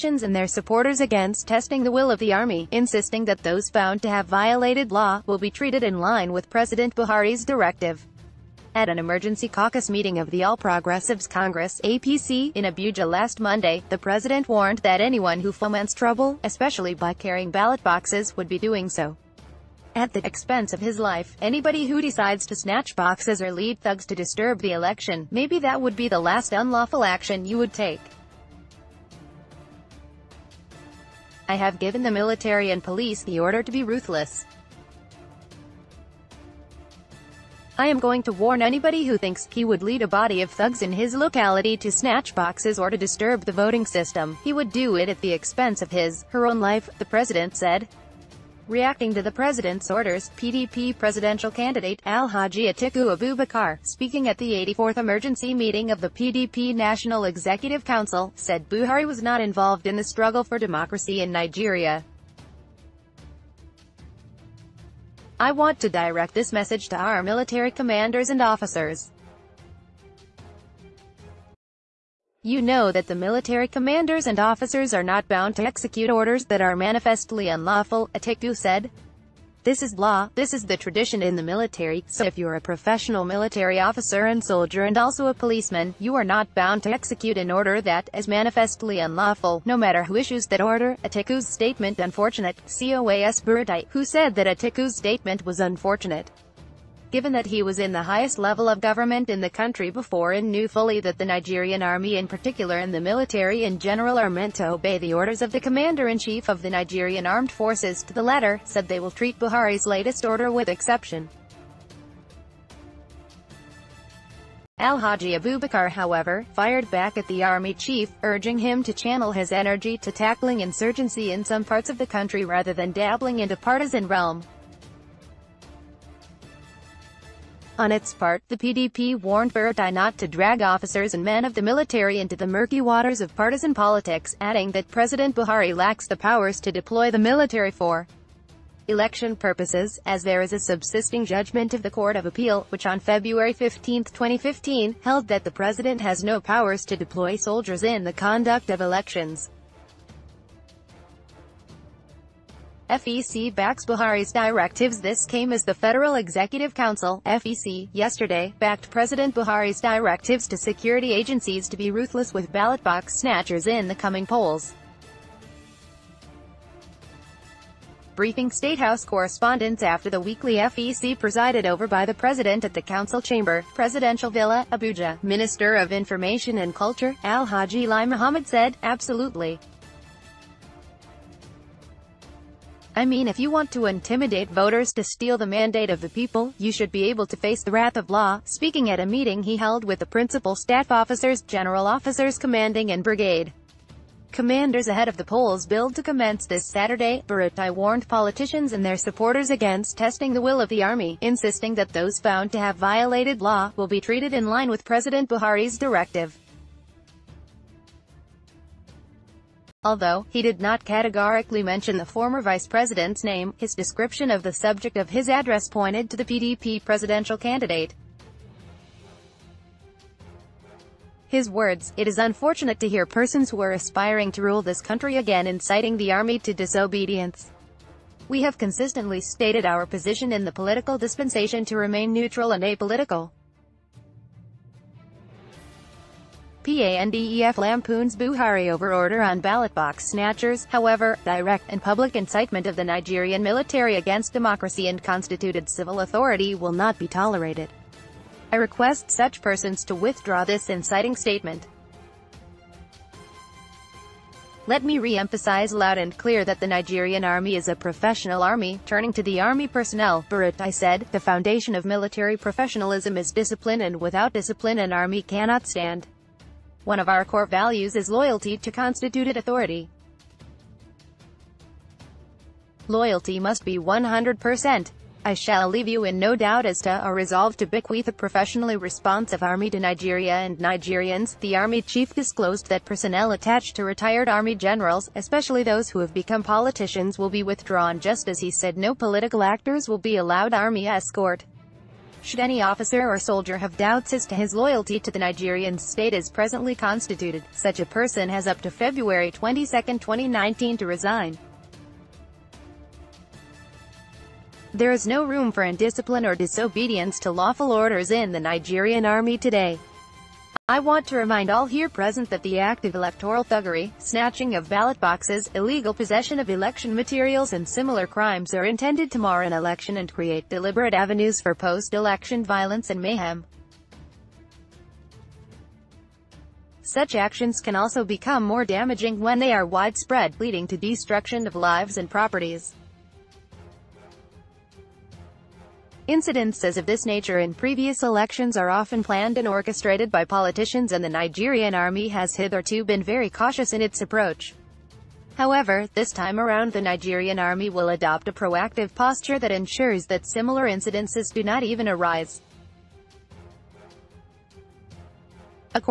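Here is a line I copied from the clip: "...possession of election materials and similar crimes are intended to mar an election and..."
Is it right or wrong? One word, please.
right.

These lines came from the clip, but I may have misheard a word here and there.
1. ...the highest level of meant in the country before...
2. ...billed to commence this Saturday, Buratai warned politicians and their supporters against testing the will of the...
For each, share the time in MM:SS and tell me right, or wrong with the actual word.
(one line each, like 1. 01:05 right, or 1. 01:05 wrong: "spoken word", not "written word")
1. 01:37 wrong: "government", not "meant"
2. 03:15 right.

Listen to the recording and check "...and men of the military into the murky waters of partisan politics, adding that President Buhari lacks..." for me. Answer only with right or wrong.
right.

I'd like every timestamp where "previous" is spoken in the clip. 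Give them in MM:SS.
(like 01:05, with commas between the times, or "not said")
05:37.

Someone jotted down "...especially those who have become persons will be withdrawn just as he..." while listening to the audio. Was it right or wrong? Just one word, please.
wrong.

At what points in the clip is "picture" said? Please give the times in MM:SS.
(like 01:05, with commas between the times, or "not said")
not said.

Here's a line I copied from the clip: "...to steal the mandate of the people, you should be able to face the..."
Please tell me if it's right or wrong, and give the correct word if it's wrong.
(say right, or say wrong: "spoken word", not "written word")
right.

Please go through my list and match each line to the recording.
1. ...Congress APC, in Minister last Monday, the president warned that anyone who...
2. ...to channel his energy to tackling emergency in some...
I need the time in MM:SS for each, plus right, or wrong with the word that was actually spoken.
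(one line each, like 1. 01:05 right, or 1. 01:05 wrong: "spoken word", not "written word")
1. 00:11 wrong: "Abuja", not "Minister"
2. 01:58 wrong: "insurgency", not "emergency".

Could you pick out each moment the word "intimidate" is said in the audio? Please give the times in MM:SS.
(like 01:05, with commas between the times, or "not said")
03:03.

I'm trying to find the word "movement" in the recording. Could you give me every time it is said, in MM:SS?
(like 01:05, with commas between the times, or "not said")
not said.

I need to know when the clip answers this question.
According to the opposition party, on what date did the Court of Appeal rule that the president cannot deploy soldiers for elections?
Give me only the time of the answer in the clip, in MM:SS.
02:22.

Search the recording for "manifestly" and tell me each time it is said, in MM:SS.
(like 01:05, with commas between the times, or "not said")
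01:16, 01:28.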